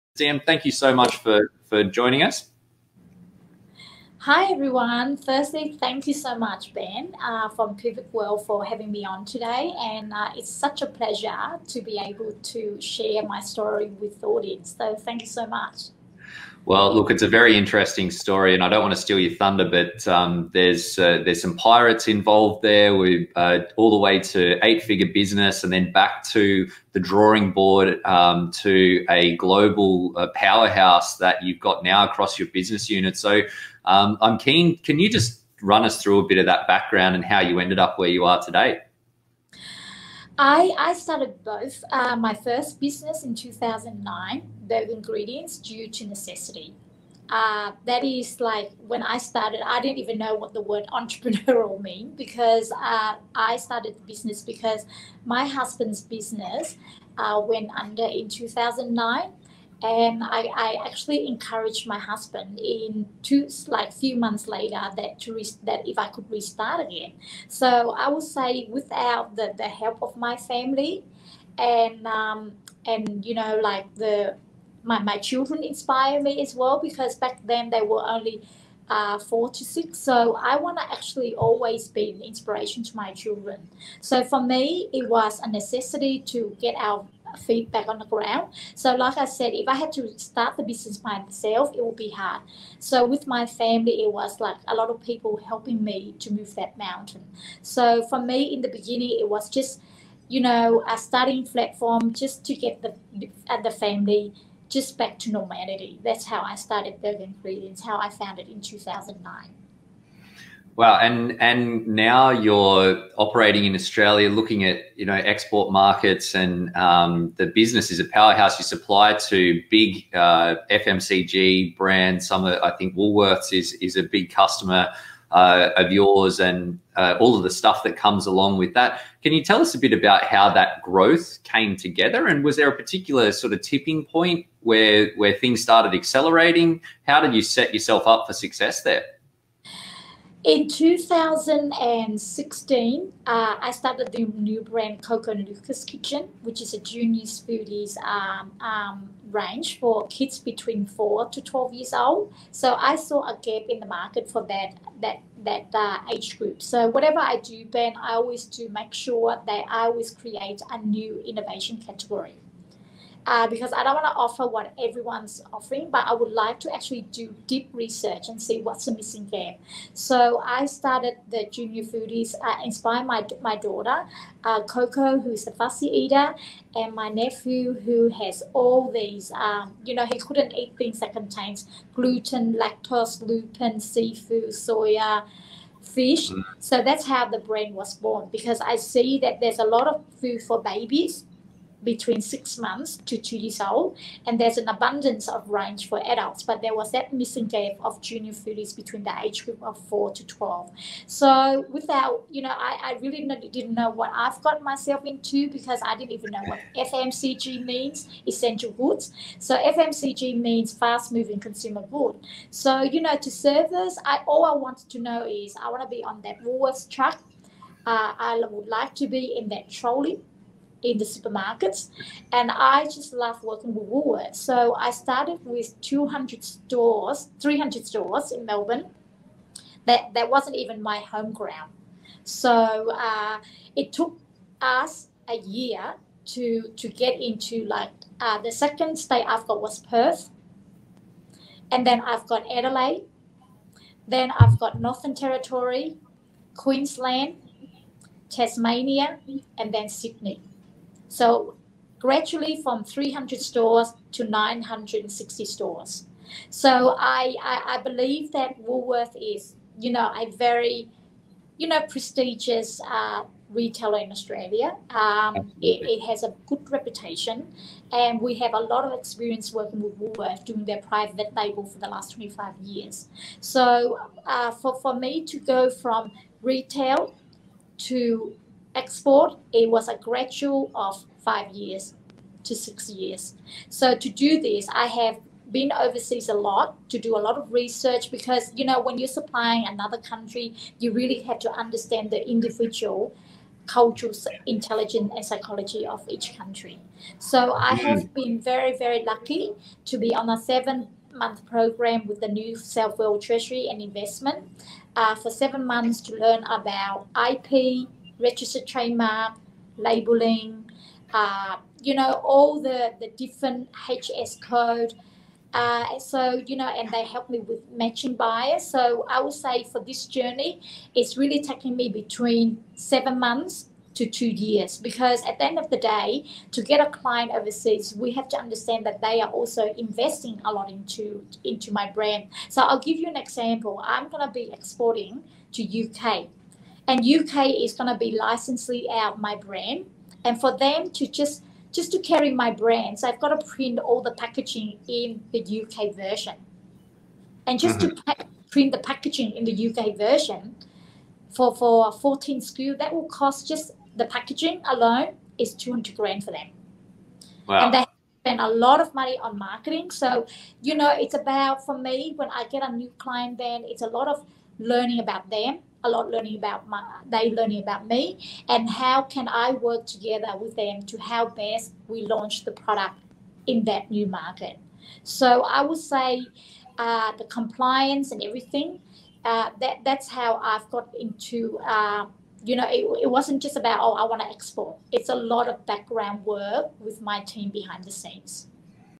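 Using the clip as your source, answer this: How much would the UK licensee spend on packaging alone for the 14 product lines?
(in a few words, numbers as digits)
200 grand.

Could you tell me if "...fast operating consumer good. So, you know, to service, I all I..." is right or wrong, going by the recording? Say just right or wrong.
wrong.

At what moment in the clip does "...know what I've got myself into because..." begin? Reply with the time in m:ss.
3:23.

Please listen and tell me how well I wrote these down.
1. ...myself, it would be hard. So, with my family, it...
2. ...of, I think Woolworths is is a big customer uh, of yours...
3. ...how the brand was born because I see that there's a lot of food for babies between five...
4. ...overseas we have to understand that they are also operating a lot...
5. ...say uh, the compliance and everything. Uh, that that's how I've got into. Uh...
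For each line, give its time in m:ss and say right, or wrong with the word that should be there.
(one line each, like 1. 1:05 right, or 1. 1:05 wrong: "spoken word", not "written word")
1. 1:31 right
2. 2:02 right
3. 3:07 wrong: "six", not "five"
4. 5:27 wrong: "investing", not "operating"
5. 6:15 right.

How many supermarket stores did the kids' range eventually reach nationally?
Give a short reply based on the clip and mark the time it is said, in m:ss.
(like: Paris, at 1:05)
960, at 4:14.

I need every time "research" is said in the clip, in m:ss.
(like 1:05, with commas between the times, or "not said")
2:47, 4:47.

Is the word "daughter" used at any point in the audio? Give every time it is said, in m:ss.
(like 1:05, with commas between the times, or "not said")
2:53.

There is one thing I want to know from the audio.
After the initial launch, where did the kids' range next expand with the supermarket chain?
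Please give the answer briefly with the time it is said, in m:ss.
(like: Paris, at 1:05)
Perth, at 3:59.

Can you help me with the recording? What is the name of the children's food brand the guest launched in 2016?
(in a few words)
Coco Lucas Kitchen.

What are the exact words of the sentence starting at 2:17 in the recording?
How did you set yourself up for success there?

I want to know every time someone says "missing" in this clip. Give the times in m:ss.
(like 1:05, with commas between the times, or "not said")
2:48, 3:17.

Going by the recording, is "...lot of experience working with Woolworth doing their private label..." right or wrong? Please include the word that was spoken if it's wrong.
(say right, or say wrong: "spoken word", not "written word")
right.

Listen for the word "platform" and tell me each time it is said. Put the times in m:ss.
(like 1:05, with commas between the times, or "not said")
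1:41.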